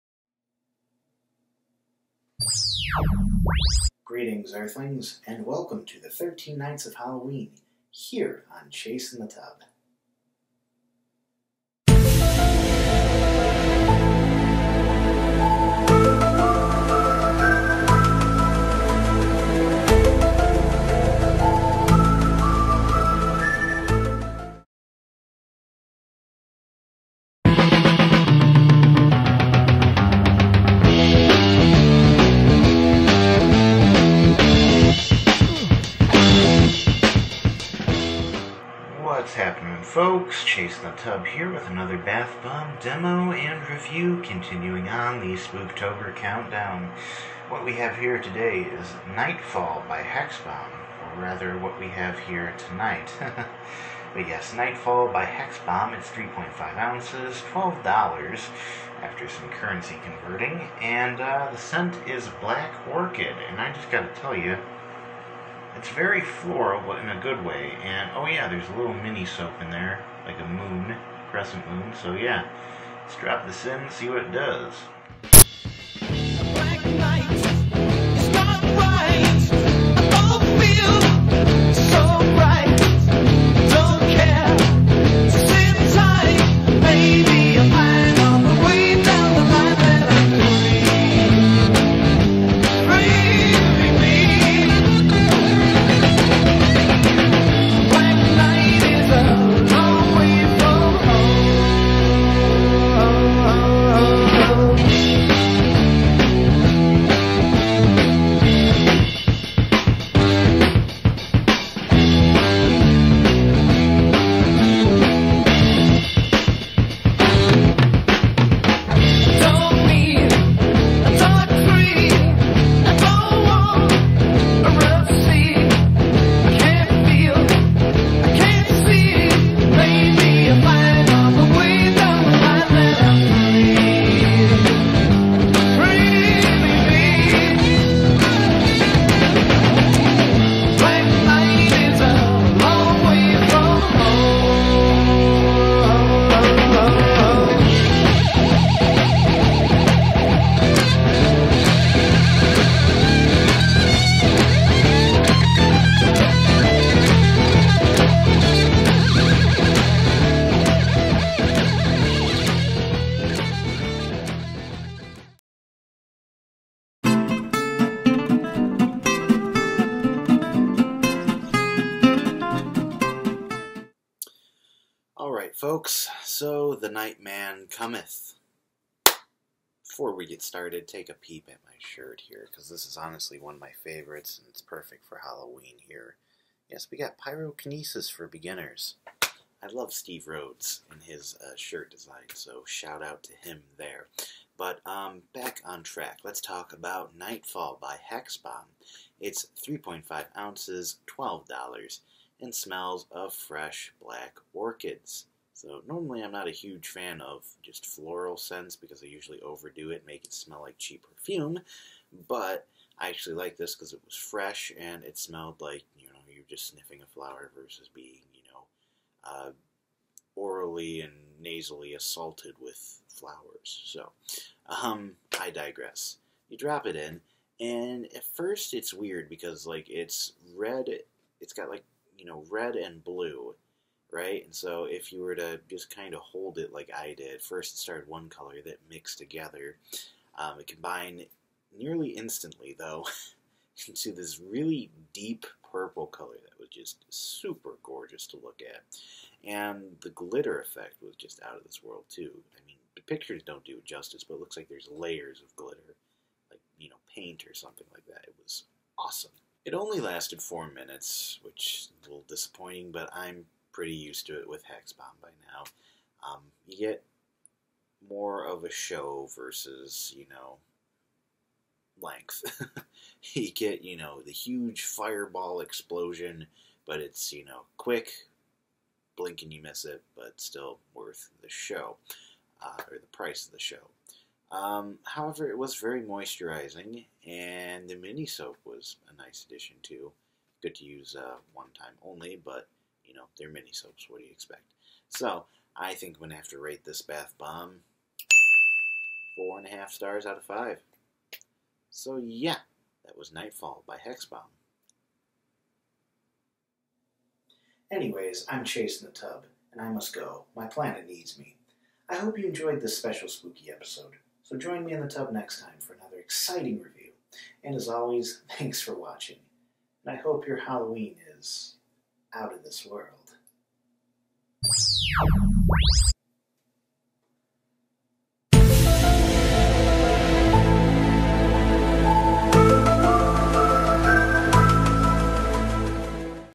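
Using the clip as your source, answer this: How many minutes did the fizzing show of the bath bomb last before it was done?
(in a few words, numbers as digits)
4.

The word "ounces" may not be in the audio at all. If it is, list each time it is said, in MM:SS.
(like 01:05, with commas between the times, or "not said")
00:56, 03:20.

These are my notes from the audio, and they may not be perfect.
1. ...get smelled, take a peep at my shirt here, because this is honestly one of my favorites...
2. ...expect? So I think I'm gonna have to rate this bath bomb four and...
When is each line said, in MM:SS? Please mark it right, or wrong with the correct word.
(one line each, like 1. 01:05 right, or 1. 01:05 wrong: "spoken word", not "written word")
1. 03:00 wrong: "started", not "smelled"
2. 04:54 right.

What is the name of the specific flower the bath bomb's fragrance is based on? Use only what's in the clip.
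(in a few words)
Black Orchid.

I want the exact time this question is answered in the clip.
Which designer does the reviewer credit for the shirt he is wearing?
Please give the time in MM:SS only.
03:09.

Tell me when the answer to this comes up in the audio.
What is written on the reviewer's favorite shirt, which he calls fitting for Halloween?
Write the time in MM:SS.
03:07.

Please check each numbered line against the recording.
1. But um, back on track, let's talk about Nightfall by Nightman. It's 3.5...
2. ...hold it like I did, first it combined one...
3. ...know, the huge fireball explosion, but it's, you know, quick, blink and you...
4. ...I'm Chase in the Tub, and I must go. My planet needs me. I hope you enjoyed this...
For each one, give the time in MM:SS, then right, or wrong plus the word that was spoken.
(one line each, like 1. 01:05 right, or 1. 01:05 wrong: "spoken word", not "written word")
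1. 03:14 wrong: "Hexbomb", not "Nightman"
2. 03:56 wrong: "started", not "combined"
3. 04:33 right
4. 05:08 right.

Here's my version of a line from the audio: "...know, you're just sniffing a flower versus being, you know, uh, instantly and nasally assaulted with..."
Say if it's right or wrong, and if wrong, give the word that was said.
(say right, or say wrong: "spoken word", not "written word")
wrong: "orally", not "instantly".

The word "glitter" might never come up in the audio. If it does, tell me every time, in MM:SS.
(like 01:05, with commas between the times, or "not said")
04:10, 04:15.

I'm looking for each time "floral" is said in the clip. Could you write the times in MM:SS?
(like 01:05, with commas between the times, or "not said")
01:06, 03:27.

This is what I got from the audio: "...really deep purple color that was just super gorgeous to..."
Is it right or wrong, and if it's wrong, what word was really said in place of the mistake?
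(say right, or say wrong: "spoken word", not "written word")
right.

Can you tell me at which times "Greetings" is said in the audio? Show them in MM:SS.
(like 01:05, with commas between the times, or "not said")
00:04.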